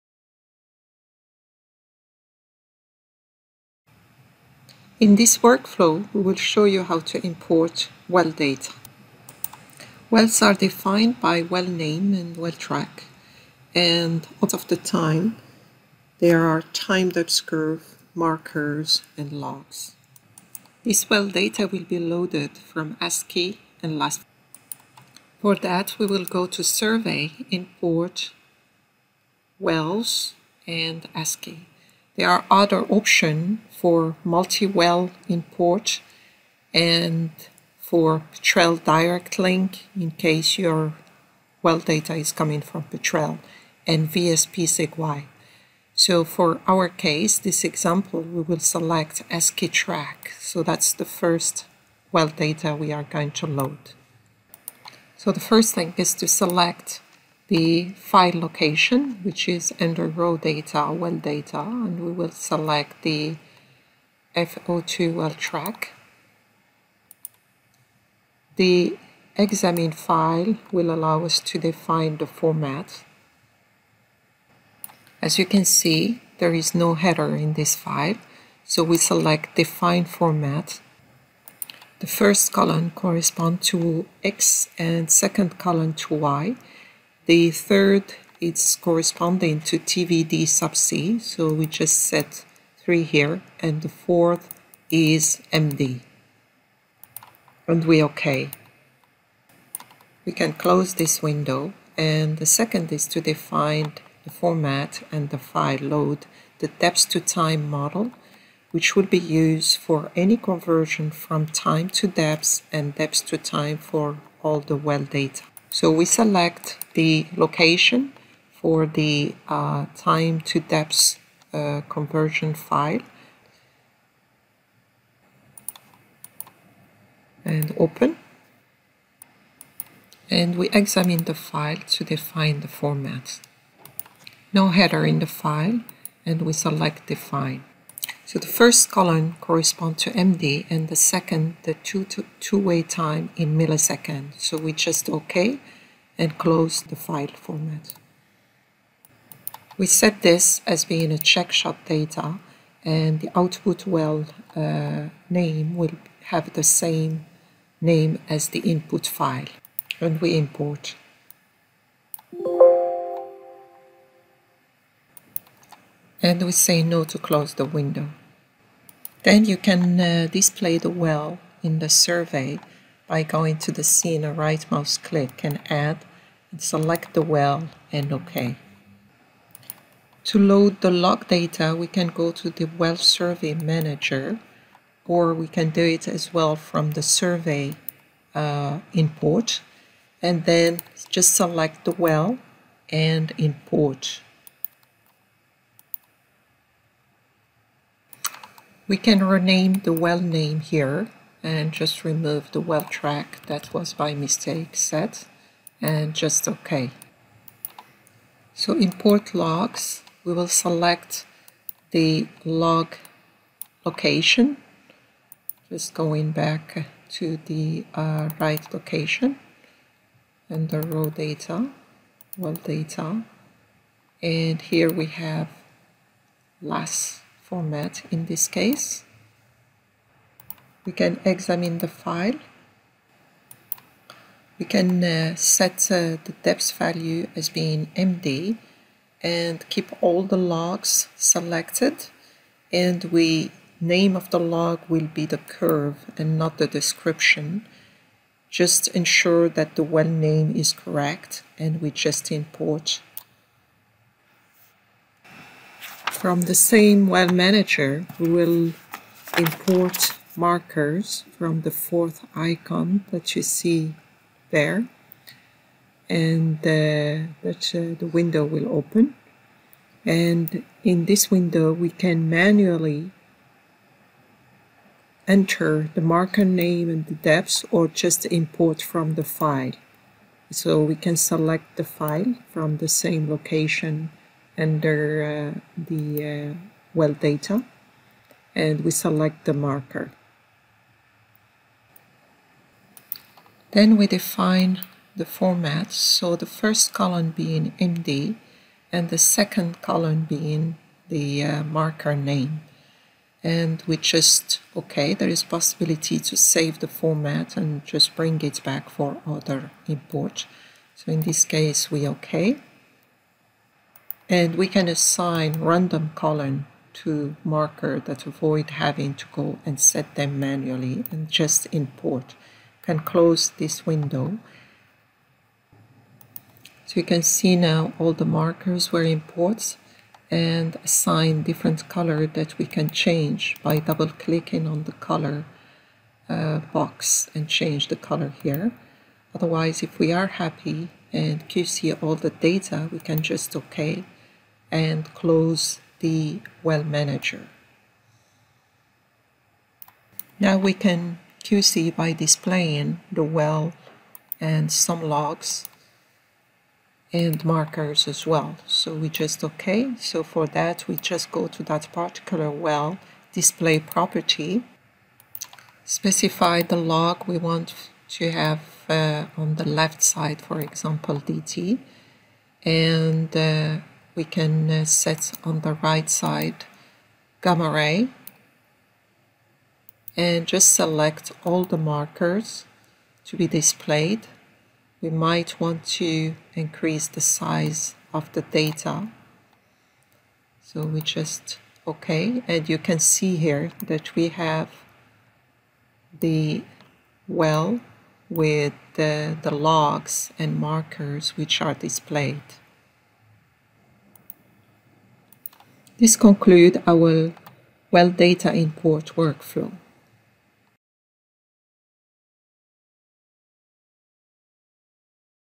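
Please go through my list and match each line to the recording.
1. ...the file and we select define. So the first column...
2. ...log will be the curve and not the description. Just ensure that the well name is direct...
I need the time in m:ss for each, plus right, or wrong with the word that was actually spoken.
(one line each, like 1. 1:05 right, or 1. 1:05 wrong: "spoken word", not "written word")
1. 2:15 right
2. 4:04 wrong: "correct", not "direct".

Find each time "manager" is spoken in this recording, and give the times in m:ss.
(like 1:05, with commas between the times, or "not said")
3:03, 4:17, 5:46.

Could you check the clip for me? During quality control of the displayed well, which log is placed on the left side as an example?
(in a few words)
DT.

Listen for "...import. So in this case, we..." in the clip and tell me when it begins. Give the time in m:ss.
5:09.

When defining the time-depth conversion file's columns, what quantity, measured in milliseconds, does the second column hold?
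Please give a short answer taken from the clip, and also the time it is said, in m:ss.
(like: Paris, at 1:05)
two-way time, at 2:22.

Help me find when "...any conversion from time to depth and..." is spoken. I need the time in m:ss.
1:50.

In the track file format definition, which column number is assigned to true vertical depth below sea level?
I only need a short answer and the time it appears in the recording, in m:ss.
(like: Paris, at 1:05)
3, at 1:32.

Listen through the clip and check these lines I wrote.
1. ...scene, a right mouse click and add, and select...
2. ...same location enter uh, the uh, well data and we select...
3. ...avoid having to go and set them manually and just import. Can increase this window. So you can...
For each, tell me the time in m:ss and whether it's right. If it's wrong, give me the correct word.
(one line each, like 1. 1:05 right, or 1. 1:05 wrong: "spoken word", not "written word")
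1. 2:53 right
2. 4:43 wrong: "under", not "enter"
3. 5:18 wrong: "close", not "increase".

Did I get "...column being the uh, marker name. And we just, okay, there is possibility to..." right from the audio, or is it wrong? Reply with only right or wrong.
right.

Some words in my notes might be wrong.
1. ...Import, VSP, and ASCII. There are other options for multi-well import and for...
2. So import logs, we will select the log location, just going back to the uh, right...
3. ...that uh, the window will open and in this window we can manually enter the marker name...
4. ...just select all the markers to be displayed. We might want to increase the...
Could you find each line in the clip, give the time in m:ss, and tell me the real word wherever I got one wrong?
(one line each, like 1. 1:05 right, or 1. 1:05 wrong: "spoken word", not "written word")
1. 0:27 wrong: "Wells", not "VSP"
2. 3:28 right
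3. 4:27 right
4. 6:20 right.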